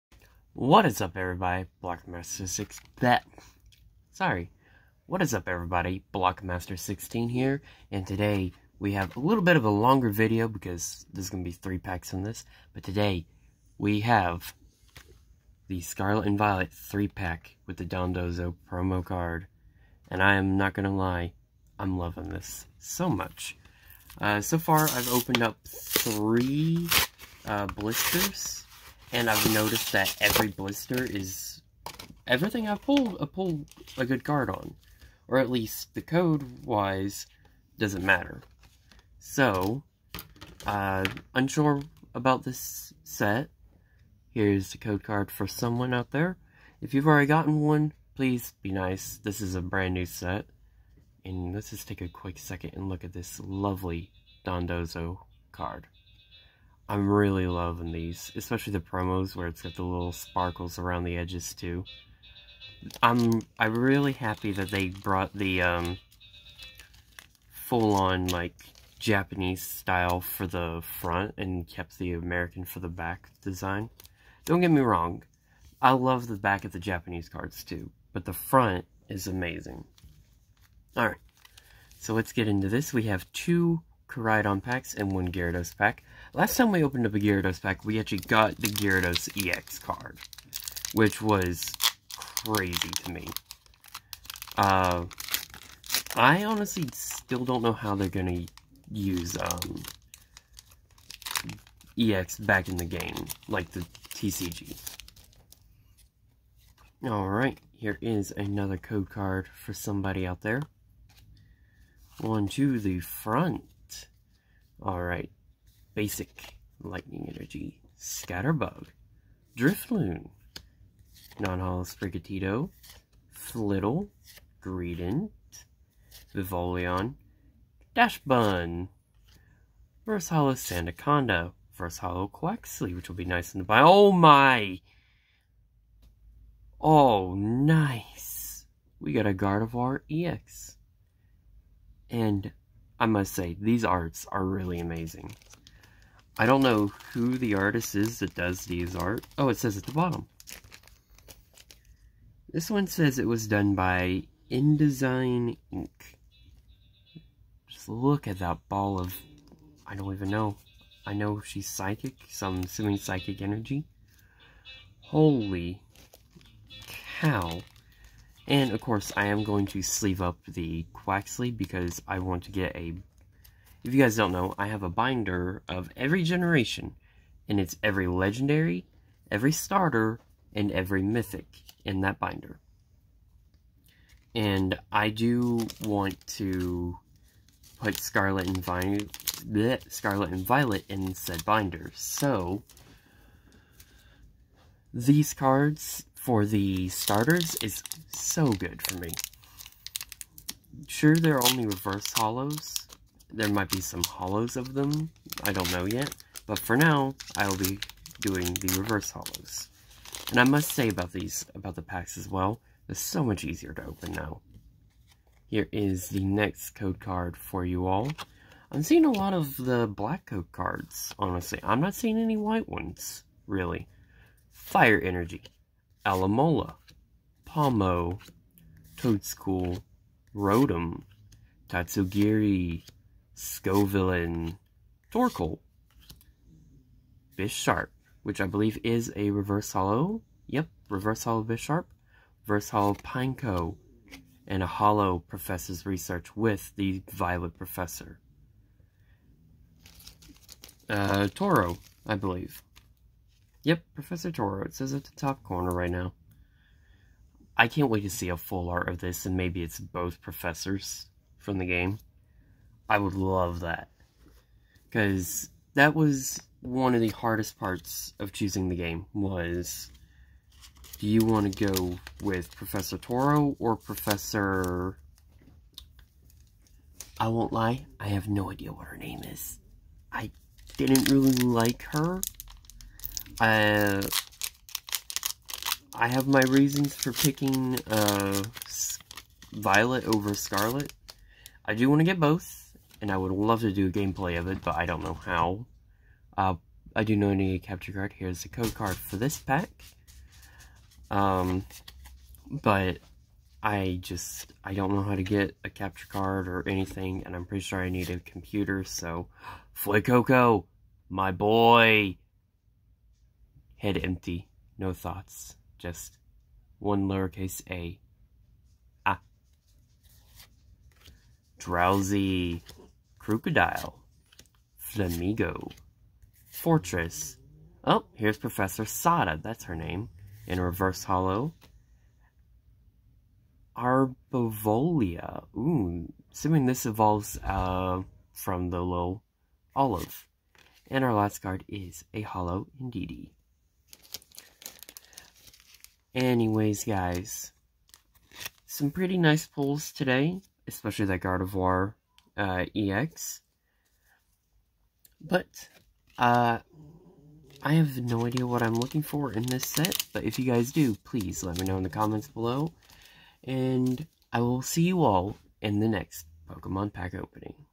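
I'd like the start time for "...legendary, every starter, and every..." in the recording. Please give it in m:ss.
2:58.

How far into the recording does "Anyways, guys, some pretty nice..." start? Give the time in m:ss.
5:46.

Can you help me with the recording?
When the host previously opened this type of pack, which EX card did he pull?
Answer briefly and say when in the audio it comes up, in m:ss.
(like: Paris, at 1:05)
Gyarados EX, at 1:28.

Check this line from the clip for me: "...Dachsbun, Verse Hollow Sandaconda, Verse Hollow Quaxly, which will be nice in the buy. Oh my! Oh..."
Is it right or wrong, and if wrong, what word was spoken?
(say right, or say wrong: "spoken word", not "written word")
right.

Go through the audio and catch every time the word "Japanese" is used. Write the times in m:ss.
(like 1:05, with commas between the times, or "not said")
1:08, 1:16.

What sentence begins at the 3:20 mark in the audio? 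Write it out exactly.
Sure, they're only reverse hollows, there might be some hollows of them.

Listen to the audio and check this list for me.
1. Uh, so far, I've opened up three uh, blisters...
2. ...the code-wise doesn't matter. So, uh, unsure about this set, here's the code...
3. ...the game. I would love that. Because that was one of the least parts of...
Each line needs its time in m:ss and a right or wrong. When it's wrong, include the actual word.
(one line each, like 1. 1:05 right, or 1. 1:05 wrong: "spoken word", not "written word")
1. 0:24 right
2. 0:35 right
3. 4:21 wrong: "hardest", not "least".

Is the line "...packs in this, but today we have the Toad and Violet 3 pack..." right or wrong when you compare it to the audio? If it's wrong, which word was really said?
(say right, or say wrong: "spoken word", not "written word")
wrong: "Scarlet", not "Toad".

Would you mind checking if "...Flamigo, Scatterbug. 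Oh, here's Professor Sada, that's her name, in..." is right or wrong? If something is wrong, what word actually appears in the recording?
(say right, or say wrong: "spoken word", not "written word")
wrong: "Forretress", not "Scatterbug".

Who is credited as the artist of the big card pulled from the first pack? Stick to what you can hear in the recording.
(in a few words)
InDesign Inc.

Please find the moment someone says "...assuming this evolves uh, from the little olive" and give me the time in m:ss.
5:36.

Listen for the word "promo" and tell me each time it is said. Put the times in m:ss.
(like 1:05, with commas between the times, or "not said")
0:18, 0:58.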